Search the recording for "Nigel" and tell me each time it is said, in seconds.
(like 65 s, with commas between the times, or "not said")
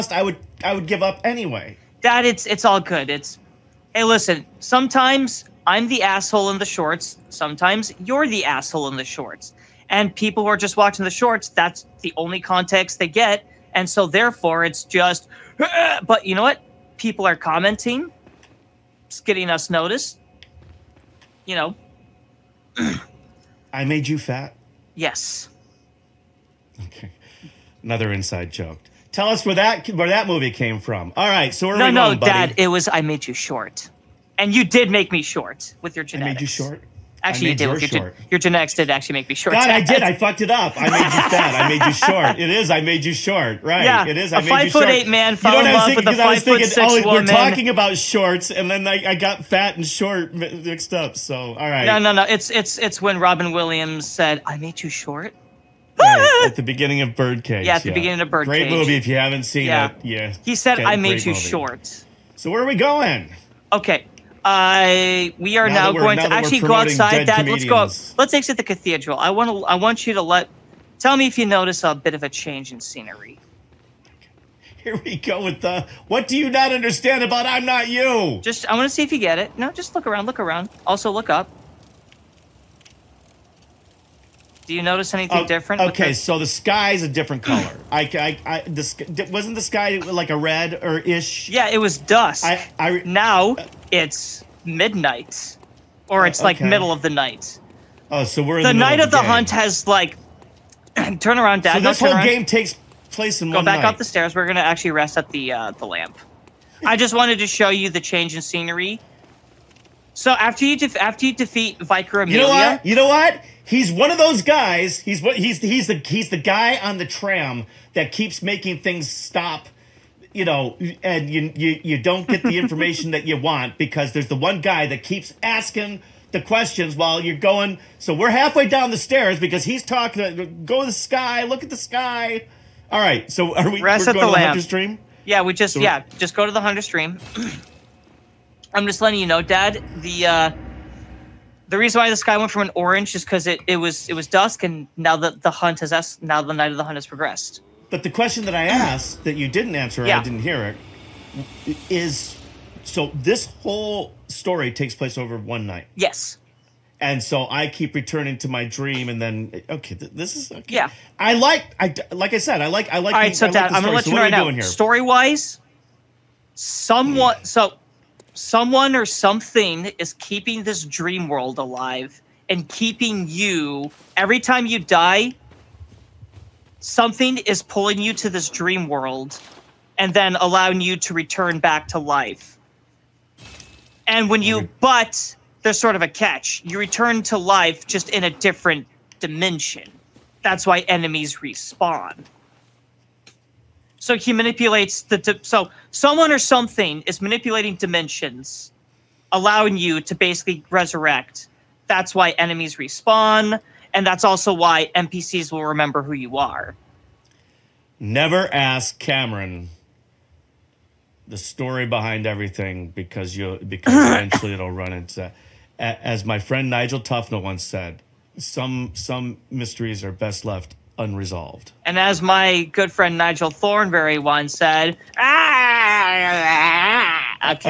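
216 s, 223 s.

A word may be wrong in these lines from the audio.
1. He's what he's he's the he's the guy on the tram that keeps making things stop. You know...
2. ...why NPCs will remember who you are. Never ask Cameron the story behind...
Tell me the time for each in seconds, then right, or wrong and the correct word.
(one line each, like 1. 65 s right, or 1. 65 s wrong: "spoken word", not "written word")
1. 115 s right
2. 204 s right.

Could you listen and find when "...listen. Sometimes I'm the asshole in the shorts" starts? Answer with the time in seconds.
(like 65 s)
4 s.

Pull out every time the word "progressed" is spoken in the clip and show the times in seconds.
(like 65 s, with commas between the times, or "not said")
147 s.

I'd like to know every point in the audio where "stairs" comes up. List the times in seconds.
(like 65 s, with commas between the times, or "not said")
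104 s, 128 s.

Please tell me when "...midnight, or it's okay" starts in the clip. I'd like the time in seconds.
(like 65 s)
94 s.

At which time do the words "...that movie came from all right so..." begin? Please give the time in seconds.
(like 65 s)
30 s.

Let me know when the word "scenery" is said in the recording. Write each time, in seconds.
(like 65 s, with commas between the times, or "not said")
72 s, 108 s.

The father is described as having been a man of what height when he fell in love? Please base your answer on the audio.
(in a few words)
5 foot 8.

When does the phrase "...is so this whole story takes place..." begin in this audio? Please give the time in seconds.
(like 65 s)
151 s.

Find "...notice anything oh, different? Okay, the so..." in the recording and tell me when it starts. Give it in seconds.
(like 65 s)
84 s.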